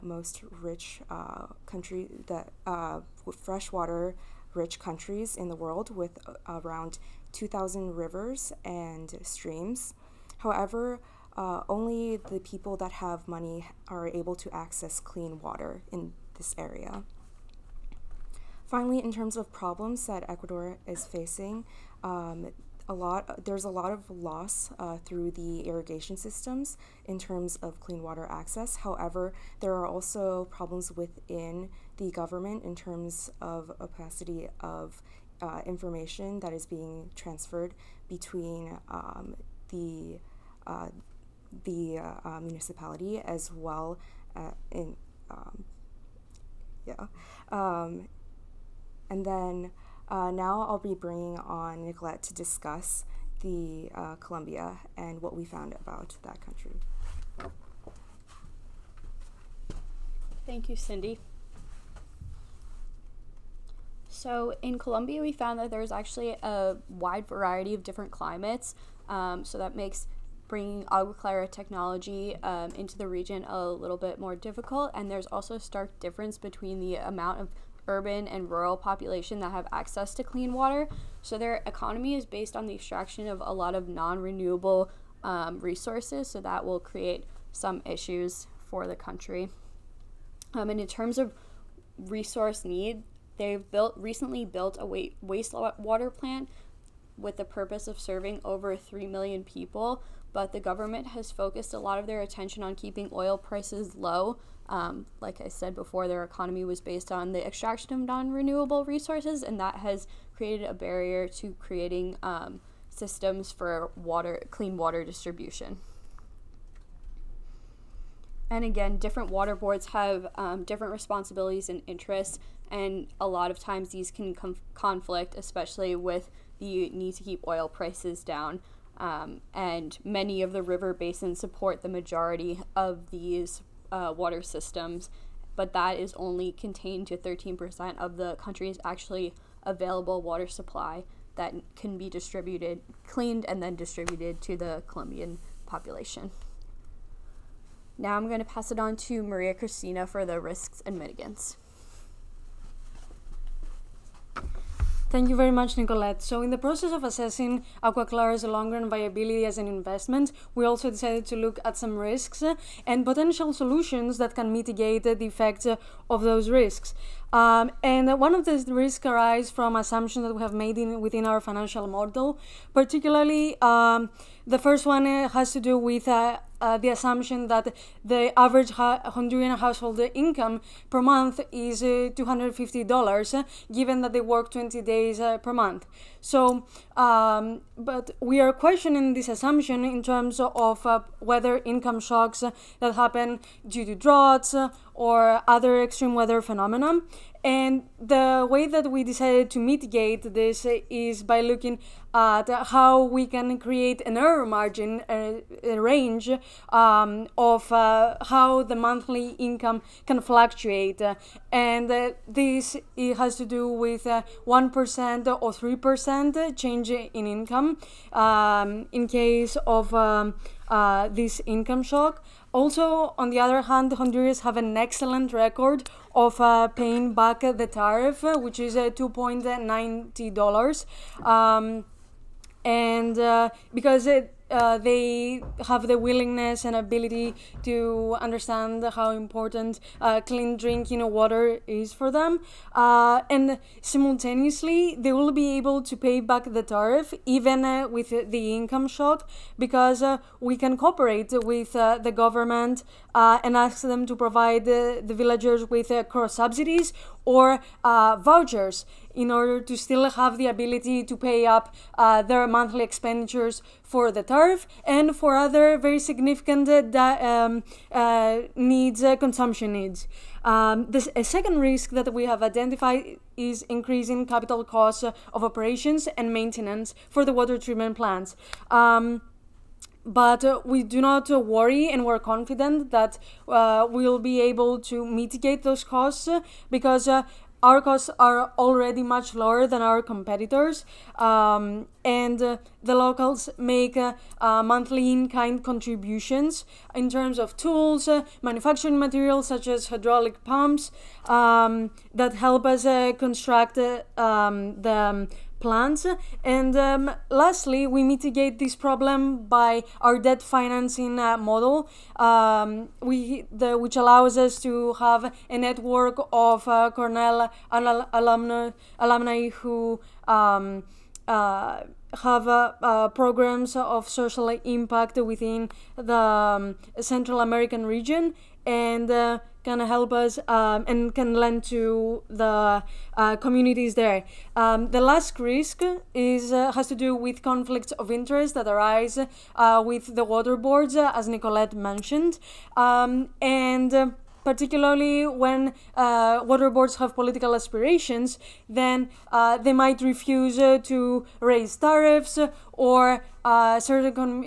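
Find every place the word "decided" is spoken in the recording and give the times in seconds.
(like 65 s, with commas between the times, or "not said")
160 s, 199 s.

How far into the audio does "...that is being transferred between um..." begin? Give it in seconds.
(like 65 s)
36 s.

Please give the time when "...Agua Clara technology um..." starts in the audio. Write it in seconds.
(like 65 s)
70 s.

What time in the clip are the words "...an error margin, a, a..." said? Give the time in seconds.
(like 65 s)
204 s.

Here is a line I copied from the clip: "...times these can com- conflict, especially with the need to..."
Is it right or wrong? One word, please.
right.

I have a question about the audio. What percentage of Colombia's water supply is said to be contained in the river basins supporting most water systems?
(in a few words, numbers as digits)
13%.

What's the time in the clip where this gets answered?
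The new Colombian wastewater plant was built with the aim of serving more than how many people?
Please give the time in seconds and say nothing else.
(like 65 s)
98 s.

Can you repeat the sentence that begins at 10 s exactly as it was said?
However, uh, only the people that have money are able to access clean water in this area.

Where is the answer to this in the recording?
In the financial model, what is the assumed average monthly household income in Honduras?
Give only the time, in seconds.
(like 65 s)
182 s.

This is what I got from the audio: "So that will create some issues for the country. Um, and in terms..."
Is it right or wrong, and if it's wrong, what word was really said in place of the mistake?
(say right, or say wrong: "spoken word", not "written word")
right.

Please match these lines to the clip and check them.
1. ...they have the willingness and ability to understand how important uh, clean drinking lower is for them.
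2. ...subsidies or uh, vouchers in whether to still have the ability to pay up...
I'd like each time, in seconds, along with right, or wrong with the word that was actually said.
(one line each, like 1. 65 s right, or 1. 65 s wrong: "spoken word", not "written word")
1. 234 s wrong: "water", not "lower"
2. 256 s wrong: "order", not "whether".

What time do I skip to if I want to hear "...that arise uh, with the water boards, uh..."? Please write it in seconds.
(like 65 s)
338 s.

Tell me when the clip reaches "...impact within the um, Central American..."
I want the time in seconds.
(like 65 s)
324 s.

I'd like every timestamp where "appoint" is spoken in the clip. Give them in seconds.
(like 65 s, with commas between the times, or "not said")
not said.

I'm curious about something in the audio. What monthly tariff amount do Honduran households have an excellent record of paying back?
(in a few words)
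$2.90.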